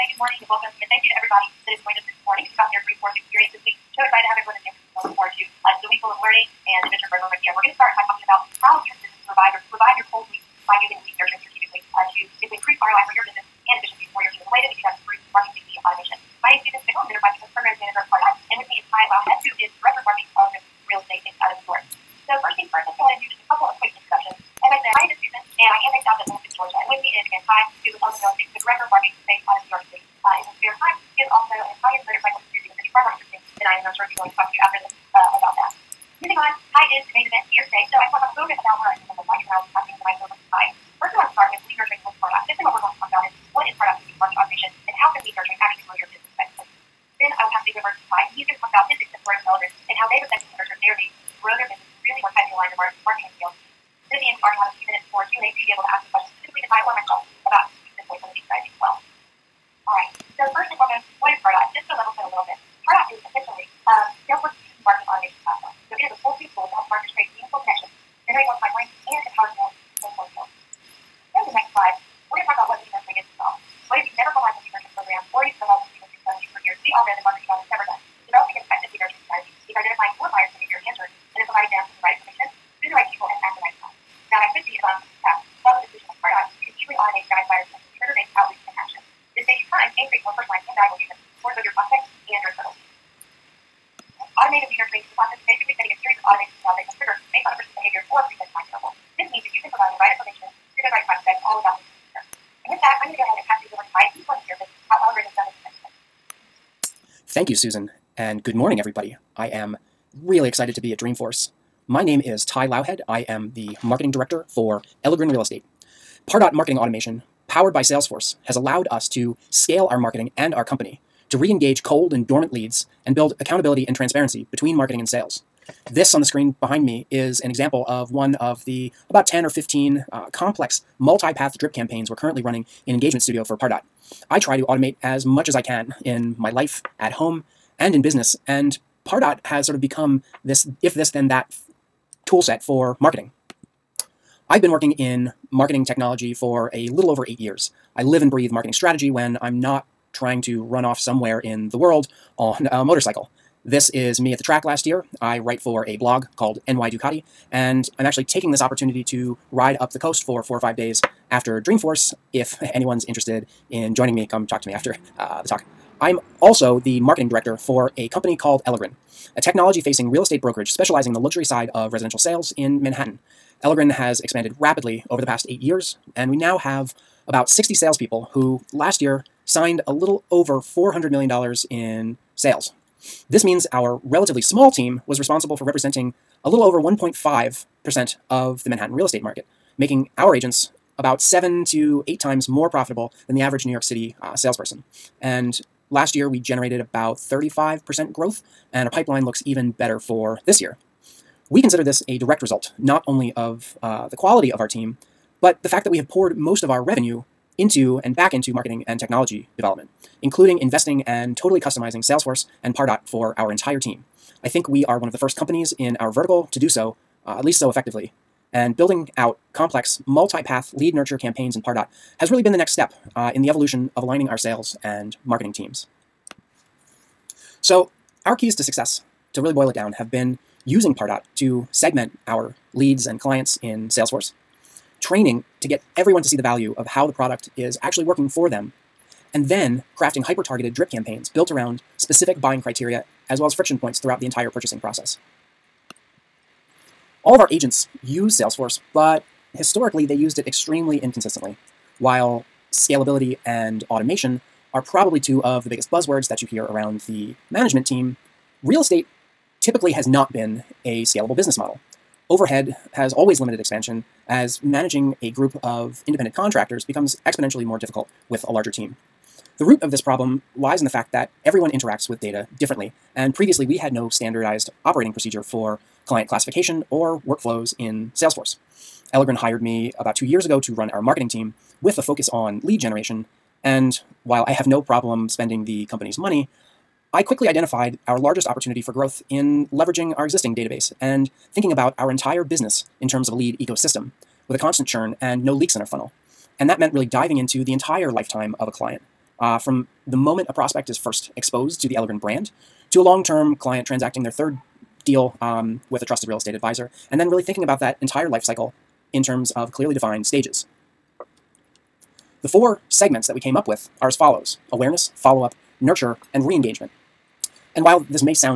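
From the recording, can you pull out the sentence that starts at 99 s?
This means that you can provide the right information to the right prospect all about the leader.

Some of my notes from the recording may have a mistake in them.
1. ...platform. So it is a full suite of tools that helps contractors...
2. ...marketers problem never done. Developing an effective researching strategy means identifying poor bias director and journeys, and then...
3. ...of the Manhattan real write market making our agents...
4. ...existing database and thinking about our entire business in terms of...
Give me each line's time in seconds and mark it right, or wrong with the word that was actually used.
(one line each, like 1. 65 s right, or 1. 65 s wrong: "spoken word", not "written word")
1. 65 s wrong: "marketers", not "contractors"
2. 77 s wrong: "behavior", not "director"
3. 188 s wrong: "estate", not "write"
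4. 290 s right.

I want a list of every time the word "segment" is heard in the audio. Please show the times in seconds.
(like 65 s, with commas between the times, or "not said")
231 s, 312 s.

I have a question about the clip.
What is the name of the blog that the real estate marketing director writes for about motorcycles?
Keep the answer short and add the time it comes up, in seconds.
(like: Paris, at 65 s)
NY Ducati, at 156 s.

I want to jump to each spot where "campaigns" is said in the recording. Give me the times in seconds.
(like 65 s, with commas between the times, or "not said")
131 s, 221 s, 240 s.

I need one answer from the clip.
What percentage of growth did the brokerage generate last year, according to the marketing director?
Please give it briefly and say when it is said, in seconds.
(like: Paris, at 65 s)
35%, at 197 s.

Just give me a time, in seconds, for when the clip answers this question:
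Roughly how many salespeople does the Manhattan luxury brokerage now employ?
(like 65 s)
177 s.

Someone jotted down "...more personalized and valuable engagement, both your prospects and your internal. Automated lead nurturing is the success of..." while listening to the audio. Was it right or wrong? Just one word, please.
wrong.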